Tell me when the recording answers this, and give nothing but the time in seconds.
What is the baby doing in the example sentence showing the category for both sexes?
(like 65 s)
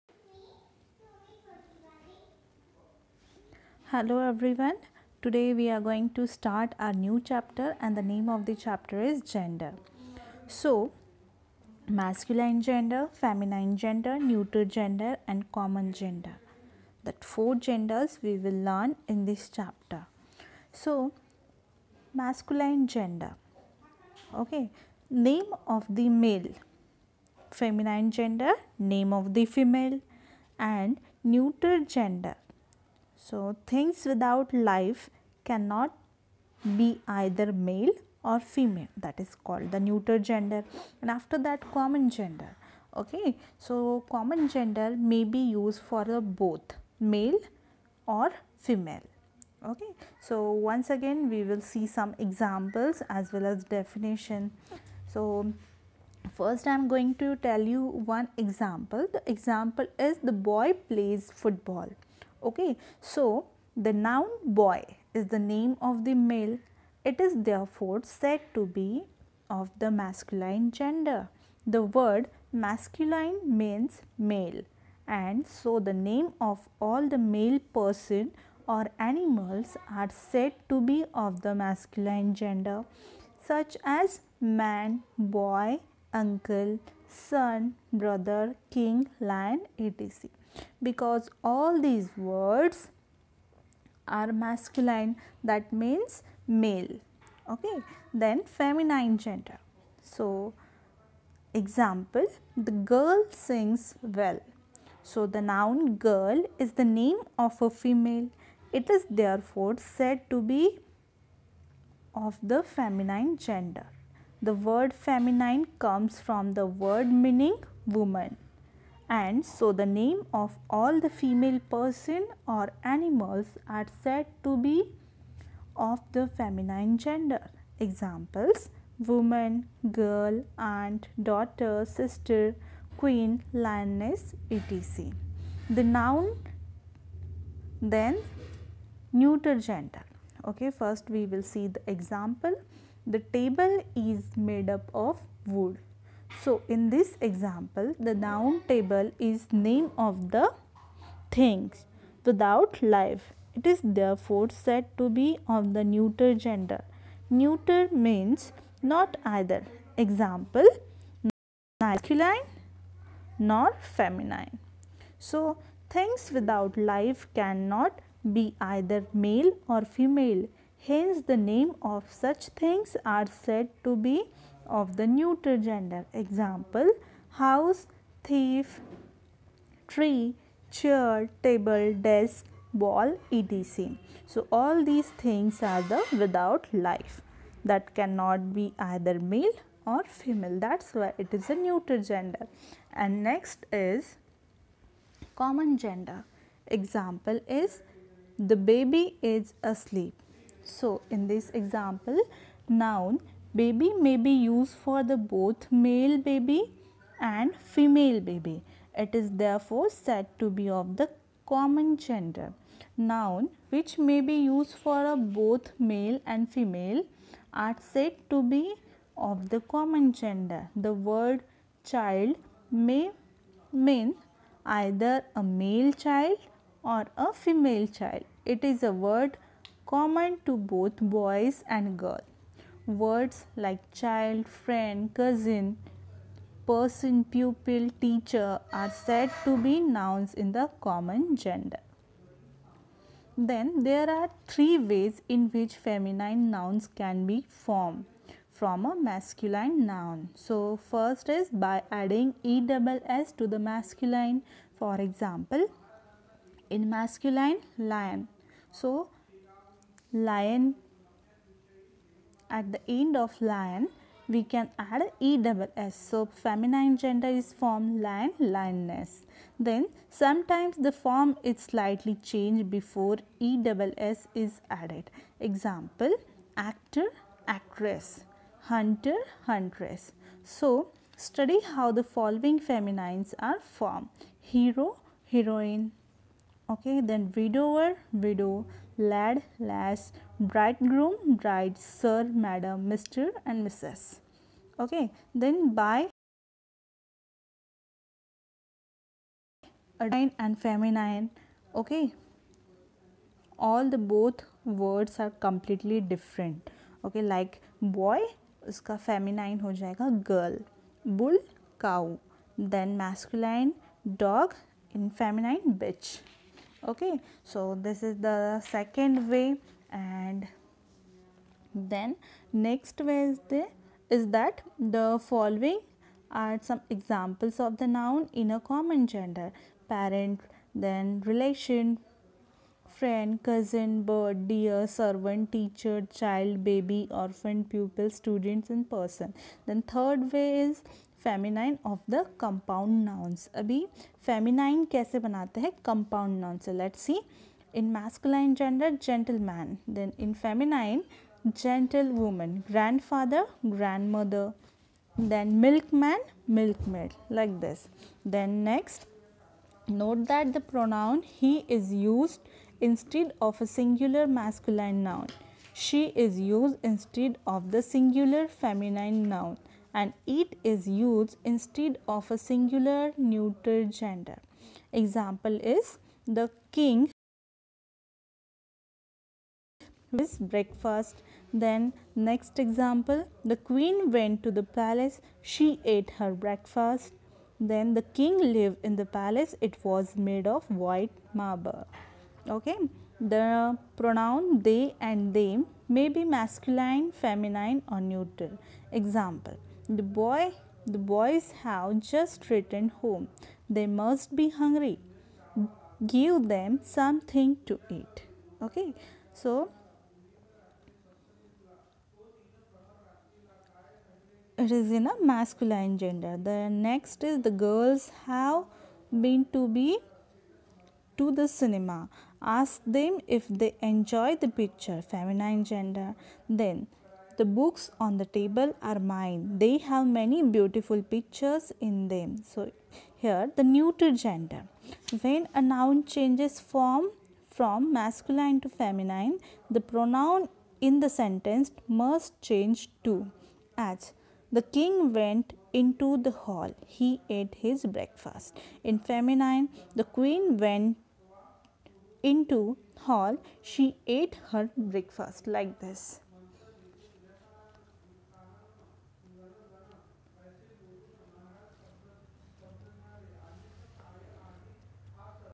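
199 s.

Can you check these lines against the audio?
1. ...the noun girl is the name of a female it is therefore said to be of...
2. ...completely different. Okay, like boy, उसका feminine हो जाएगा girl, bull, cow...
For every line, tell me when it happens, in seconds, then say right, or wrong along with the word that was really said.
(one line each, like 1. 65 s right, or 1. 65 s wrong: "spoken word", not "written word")
1. 105 s right
2. 305 s right.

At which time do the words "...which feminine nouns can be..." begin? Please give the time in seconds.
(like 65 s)
245 s.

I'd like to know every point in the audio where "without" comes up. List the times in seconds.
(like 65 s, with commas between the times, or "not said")
34 s, 152 s, 166 s, 186 s.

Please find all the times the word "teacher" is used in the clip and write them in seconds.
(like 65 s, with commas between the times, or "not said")
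237 s, 335 s.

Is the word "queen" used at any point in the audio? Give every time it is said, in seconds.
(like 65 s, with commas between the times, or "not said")
132 s, 383 s, 450 s.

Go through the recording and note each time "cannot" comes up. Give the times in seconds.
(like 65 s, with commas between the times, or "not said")
35 s, 167 s, 187 s.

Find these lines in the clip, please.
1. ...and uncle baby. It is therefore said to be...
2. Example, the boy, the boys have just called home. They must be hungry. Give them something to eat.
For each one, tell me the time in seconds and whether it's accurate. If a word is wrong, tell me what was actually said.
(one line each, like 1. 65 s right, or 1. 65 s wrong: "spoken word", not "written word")
1. 207 s wrong: "female", not "uncle"
2. 398 s wrong: "returned", not "called".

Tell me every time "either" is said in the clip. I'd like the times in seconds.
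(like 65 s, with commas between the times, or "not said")
37 s, 159 s, 168 s, 188 s, 224 s.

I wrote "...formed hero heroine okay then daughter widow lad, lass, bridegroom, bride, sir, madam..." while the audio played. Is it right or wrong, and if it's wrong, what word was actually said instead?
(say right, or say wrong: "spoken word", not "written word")
wrong: "widower", not "daughter".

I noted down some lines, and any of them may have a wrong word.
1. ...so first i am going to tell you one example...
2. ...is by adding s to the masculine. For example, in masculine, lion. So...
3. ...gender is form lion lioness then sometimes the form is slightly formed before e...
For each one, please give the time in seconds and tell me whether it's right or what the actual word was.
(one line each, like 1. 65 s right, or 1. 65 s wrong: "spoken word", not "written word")
1. 55 s right
2. 251 s right
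3. 266 s wrong: "changed", not "formed".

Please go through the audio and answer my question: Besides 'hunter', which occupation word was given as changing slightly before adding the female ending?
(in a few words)
Actor.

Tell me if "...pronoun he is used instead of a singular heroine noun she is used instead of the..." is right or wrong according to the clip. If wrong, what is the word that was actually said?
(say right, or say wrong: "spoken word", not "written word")
wrong: "masculine", not "heroine".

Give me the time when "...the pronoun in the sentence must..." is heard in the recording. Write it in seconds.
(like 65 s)
439 s.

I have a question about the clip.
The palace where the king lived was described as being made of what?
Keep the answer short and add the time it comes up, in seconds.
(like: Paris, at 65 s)
White marble, at 390 s.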